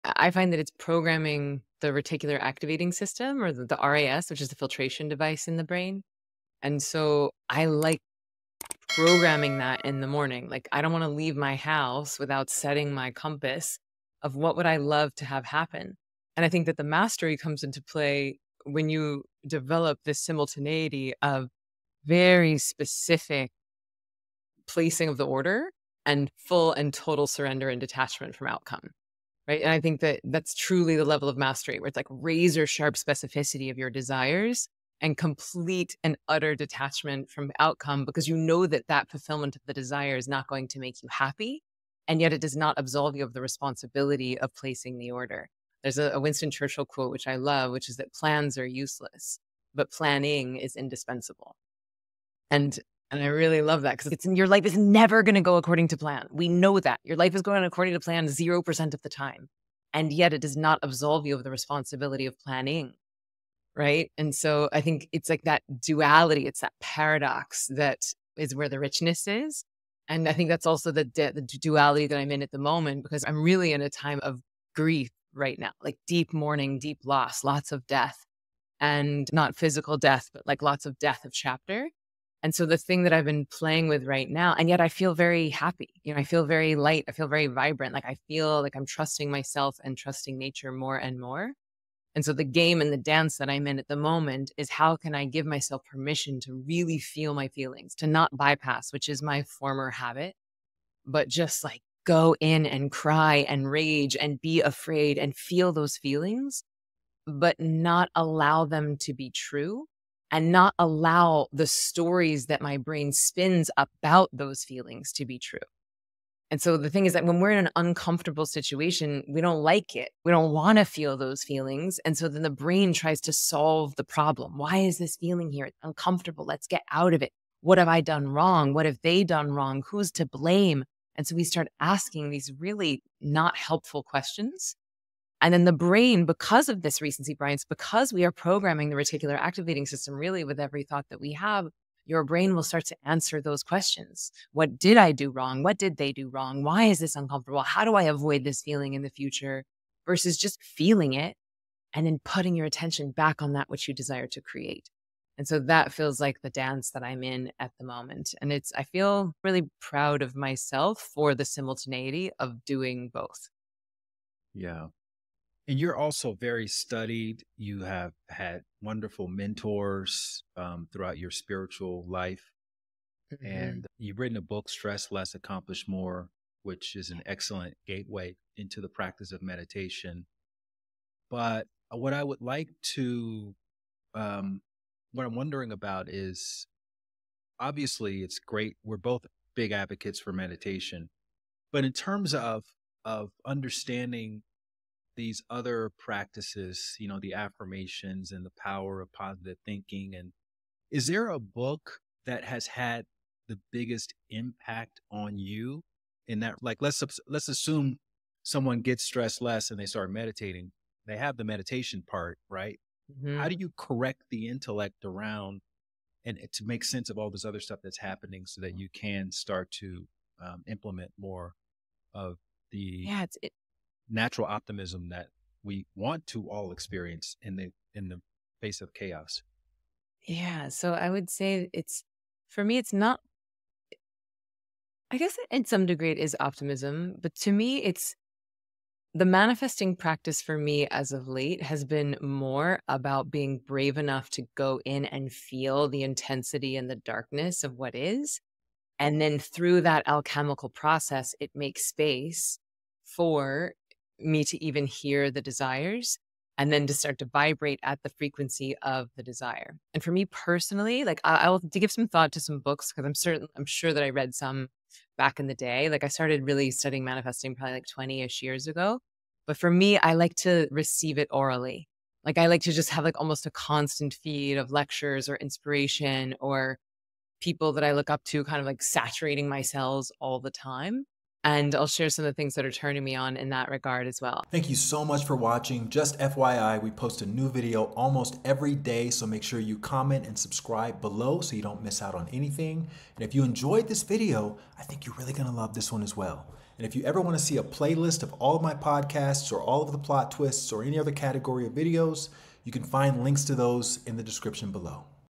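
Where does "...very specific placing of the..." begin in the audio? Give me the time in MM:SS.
00:22.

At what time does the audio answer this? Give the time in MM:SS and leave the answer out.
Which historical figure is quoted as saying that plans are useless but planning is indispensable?
00:46.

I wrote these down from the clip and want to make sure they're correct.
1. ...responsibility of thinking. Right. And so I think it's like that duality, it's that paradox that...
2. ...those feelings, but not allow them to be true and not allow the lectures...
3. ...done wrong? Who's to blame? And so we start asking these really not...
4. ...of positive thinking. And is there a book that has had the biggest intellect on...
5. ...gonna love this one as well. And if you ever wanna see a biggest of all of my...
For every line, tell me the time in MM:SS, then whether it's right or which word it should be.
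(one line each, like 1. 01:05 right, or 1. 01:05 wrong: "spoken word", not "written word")
1. 01:01 wrong: "planning", not "thinking"
2. 01:45 wrong: "stories", not "lectures"
3. 02:09 right
4. 03:19 wrong: "impact", not "intellect"
5. 04:55 wrong: "playlist", not "biggest".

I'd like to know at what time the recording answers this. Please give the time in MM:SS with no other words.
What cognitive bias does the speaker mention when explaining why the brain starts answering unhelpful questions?
02:17.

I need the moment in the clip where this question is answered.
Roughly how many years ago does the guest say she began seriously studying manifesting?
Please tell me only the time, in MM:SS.
04:27.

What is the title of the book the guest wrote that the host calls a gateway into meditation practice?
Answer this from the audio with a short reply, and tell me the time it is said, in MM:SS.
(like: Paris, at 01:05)
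Stress Less, Accomplish More, at 02:54.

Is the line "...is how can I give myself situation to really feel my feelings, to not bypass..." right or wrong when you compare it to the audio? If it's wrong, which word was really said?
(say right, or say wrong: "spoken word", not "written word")
wrong: "permission", not "situation".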